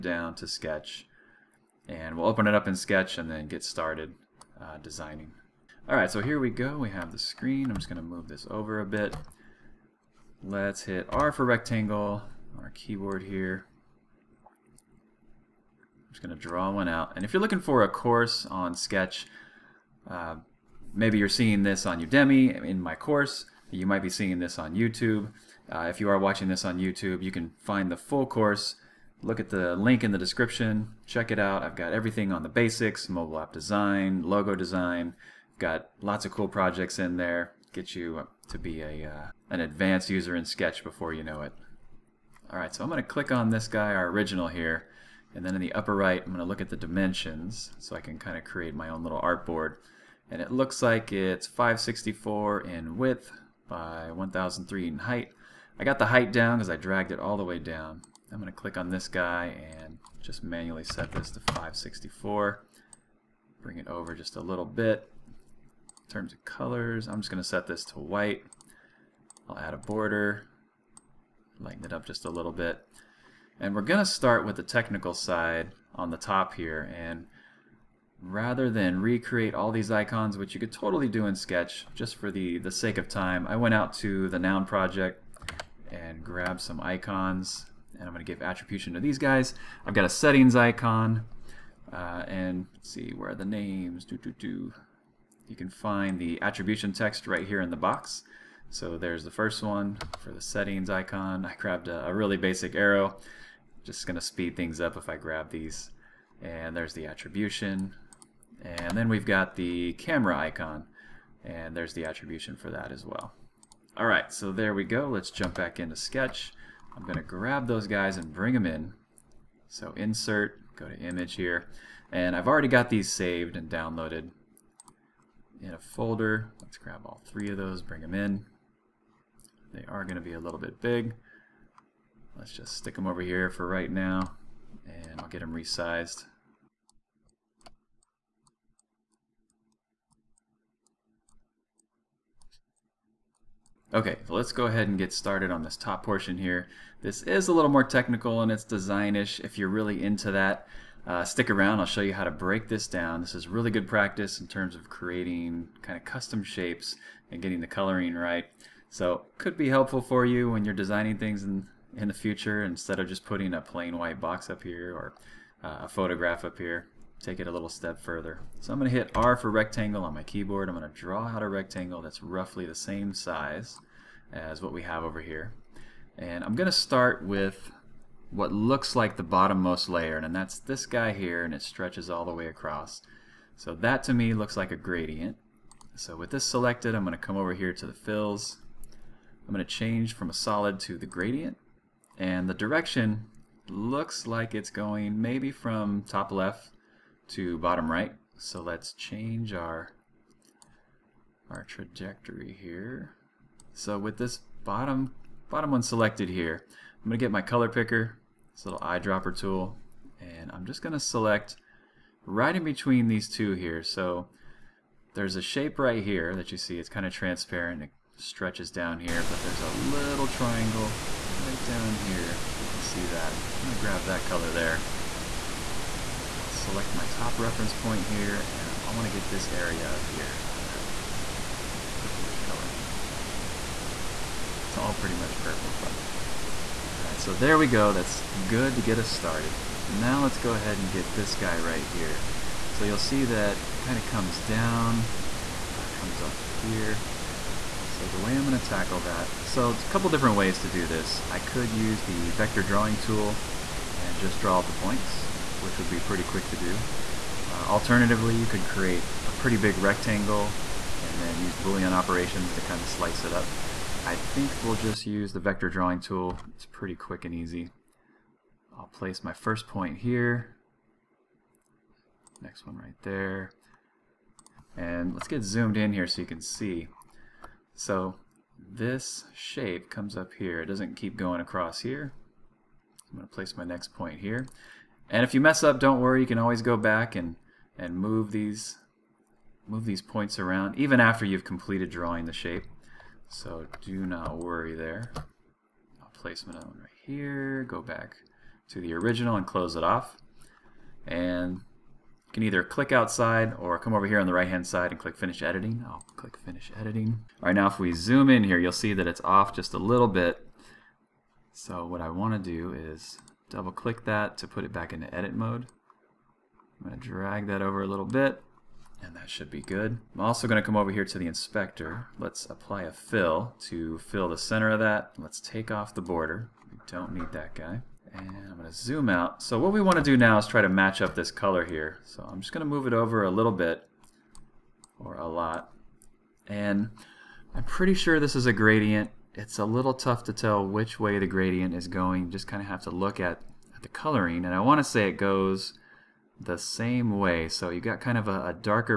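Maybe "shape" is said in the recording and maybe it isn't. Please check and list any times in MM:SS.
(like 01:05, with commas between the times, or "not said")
02:36, 03:35, 04:39, 04:52.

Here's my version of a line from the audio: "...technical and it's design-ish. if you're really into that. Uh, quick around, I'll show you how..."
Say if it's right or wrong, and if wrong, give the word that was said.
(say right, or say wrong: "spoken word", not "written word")
wrong: "stick", not "quick".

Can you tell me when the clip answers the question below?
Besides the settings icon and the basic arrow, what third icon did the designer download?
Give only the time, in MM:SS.
01:49.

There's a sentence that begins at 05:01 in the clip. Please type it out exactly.
And you can either click outside or come over here on the right hand side and click finish editing.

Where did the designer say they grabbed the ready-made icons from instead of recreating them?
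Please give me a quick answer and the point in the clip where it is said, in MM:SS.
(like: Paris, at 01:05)
The Noun Project, at 01:24.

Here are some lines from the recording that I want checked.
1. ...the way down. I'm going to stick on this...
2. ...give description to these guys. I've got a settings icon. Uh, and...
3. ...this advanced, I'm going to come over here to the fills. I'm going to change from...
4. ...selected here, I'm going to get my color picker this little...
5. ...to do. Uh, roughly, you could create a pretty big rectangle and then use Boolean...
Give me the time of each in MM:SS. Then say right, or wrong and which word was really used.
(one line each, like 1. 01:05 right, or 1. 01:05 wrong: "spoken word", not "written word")
1. 00:57 wrong: "click", not "stick"
2. 01:28 wrong: "attribution", not "description"
3. 03:06 wrong: "selected", not "advanced"
4. 03:25 right
5. 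04:16 wrong: "alternatively", not "roughly".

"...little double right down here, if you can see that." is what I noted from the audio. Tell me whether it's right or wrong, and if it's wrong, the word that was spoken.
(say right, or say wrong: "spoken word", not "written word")
wrong: "triangle", not "double".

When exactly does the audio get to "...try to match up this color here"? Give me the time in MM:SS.
05:30.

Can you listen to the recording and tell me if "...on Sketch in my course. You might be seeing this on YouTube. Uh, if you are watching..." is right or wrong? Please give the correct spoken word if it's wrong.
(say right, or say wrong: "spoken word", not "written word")
wrong: "Udemy", not "Sketch".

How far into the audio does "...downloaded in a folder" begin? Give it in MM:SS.
02:03.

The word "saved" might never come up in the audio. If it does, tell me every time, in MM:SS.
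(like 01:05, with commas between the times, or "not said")
02:03.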